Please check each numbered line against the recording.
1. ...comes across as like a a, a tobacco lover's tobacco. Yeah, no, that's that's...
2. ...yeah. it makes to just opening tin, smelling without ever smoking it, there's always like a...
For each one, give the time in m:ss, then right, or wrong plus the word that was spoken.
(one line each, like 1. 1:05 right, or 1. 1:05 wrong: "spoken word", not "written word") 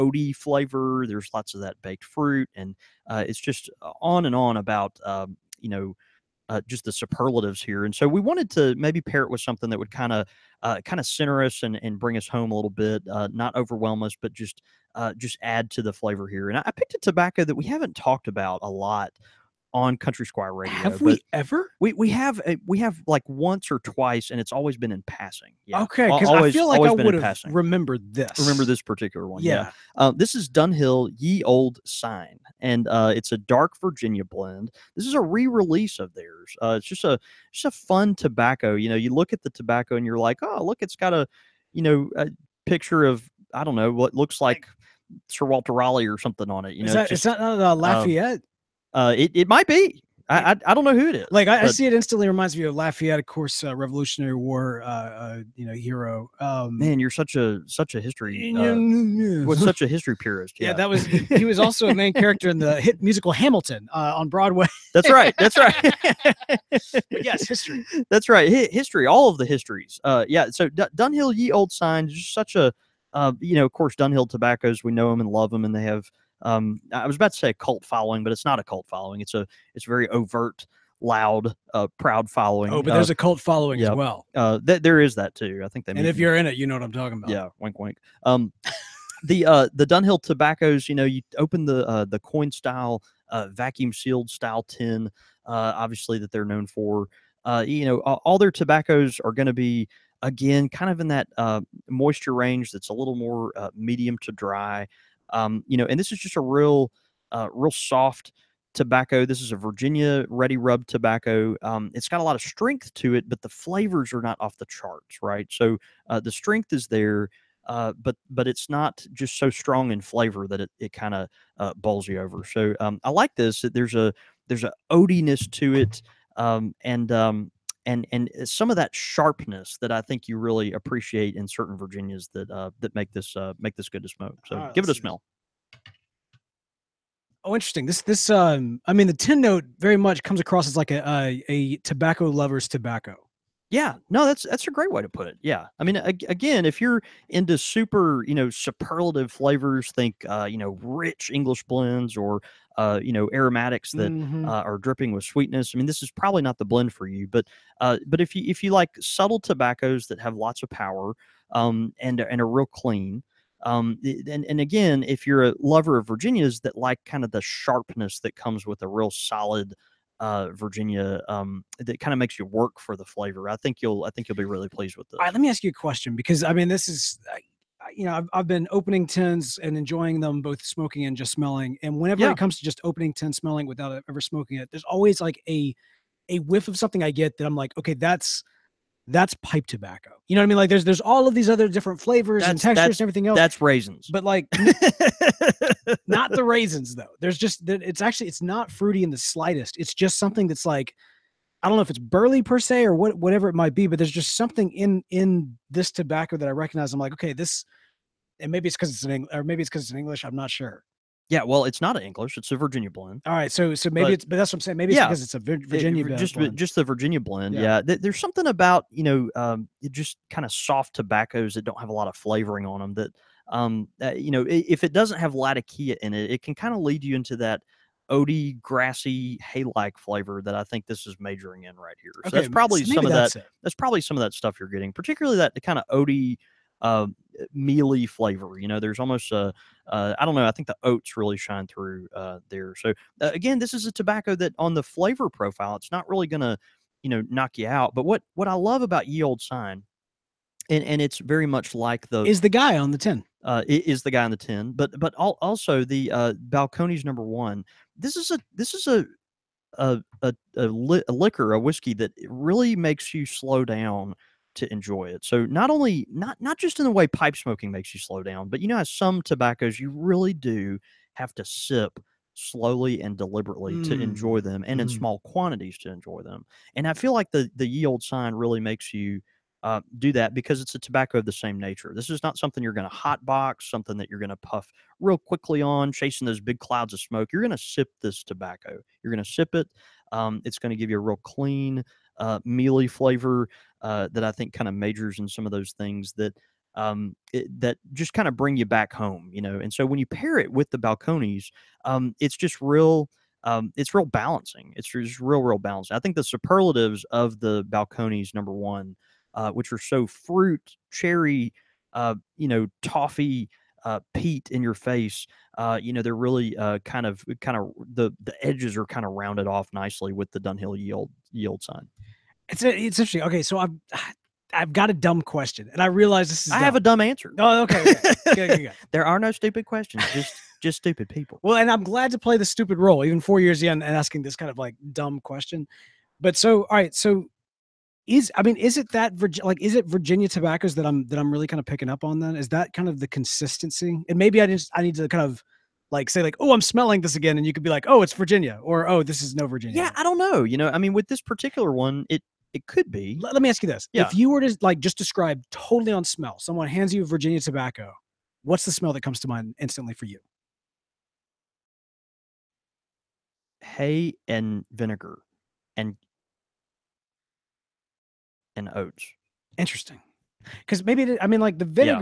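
1. 2:20 right
2. 3:02 wrong: "comes", not "makes".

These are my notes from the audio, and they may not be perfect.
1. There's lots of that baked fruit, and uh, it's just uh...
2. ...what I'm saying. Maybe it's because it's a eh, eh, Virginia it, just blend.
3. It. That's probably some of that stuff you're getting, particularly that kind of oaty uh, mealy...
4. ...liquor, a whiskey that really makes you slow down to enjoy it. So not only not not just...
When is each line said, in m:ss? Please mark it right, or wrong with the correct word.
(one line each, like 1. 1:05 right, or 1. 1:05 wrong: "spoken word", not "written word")
1. 0:01 right
2. 3:34 right
3. 3:53 right
4. 4:21 right.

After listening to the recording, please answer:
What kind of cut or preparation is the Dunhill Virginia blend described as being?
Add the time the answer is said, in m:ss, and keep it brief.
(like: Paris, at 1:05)
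ready rub, at 1:50.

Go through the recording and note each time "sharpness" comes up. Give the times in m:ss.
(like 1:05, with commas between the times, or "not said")
2:08, 2:47.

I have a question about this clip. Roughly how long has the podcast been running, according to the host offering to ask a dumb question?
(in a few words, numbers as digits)
4 years.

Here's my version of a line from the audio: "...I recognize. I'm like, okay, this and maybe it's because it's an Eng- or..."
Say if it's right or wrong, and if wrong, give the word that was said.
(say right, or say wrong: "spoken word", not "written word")
right.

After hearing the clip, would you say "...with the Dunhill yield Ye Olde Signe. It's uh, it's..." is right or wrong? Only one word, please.
right.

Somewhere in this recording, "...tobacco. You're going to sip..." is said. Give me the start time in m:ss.
4:48.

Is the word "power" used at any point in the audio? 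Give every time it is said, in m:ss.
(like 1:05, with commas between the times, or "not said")
2:40.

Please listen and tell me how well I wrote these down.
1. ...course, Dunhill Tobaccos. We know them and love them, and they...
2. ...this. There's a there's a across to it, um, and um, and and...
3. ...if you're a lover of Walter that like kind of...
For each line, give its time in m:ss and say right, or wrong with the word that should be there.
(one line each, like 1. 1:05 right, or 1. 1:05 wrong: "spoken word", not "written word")
1. 1:13 right
2. 2:03 wrong: "odiness", not "across"
3. 2:45 wrong: "Virginias", not "Walter".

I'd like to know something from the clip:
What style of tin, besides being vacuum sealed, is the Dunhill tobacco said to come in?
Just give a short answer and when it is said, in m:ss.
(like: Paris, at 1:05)
coin style, at 1:32.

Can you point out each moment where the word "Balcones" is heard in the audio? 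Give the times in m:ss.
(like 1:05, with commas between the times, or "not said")
4:16, 5:00, 5:07.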